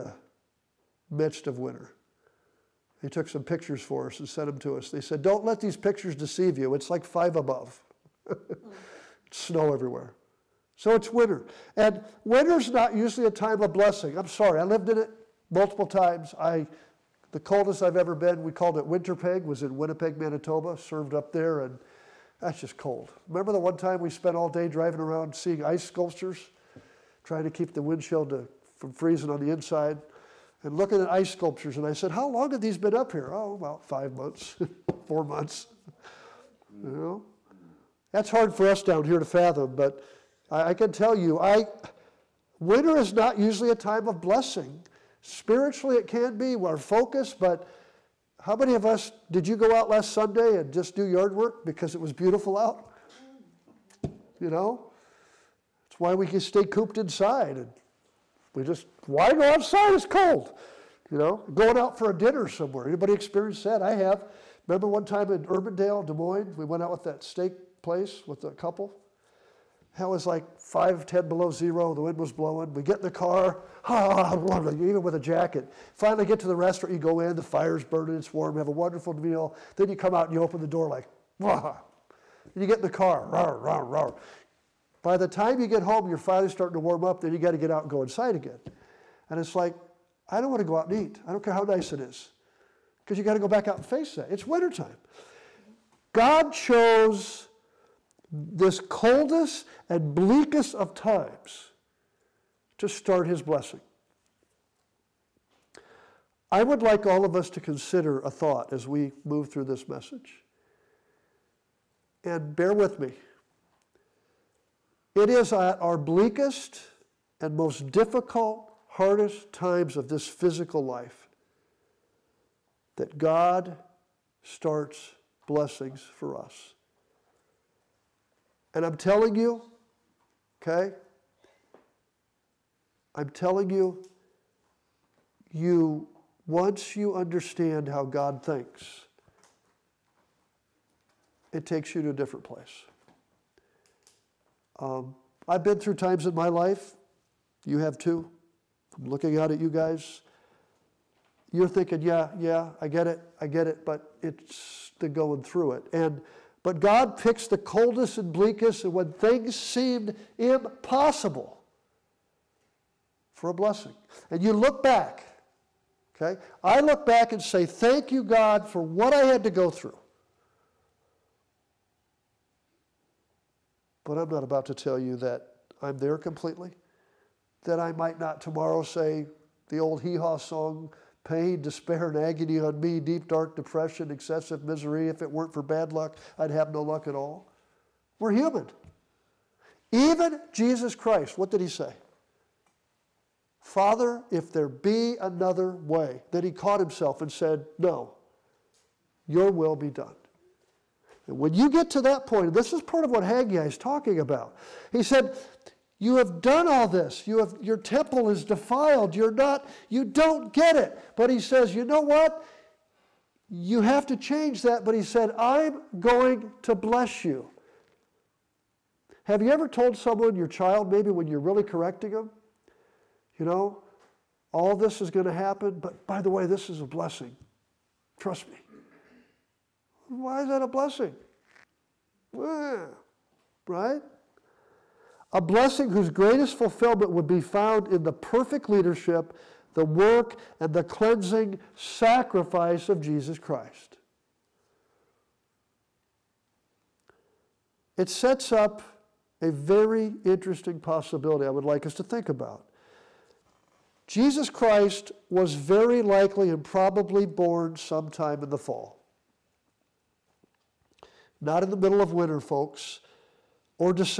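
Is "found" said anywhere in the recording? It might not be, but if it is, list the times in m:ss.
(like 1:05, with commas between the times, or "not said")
3:57.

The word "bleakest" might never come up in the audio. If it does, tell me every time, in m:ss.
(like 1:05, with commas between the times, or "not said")
1:40, 1:55, 2:38.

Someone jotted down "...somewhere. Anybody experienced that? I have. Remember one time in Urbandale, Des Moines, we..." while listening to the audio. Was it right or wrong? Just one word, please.
right.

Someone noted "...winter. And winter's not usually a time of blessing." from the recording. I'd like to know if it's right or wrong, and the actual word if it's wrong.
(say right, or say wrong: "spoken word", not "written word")
right.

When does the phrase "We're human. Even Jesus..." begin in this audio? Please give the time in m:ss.
3:08.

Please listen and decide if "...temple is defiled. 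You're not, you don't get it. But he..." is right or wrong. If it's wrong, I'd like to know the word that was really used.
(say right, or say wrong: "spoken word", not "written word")
right.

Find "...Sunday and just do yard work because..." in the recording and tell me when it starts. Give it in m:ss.
0:50.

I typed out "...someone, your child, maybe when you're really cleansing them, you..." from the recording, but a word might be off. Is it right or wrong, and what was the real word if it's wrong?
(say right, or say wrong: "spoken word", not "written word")
wrong: "correcting", not "cleansing".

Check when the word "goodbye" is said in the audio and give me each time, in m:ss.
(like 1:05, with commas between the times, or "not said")
not said.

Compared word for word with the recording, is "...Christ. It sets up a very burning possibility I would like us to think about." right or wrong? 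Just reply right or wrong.
wrong.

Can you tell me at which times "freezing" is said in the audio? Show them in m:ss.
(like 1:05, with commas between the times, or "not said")
0:28.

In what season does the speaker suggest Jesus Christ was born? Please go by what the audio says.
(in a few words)
fall.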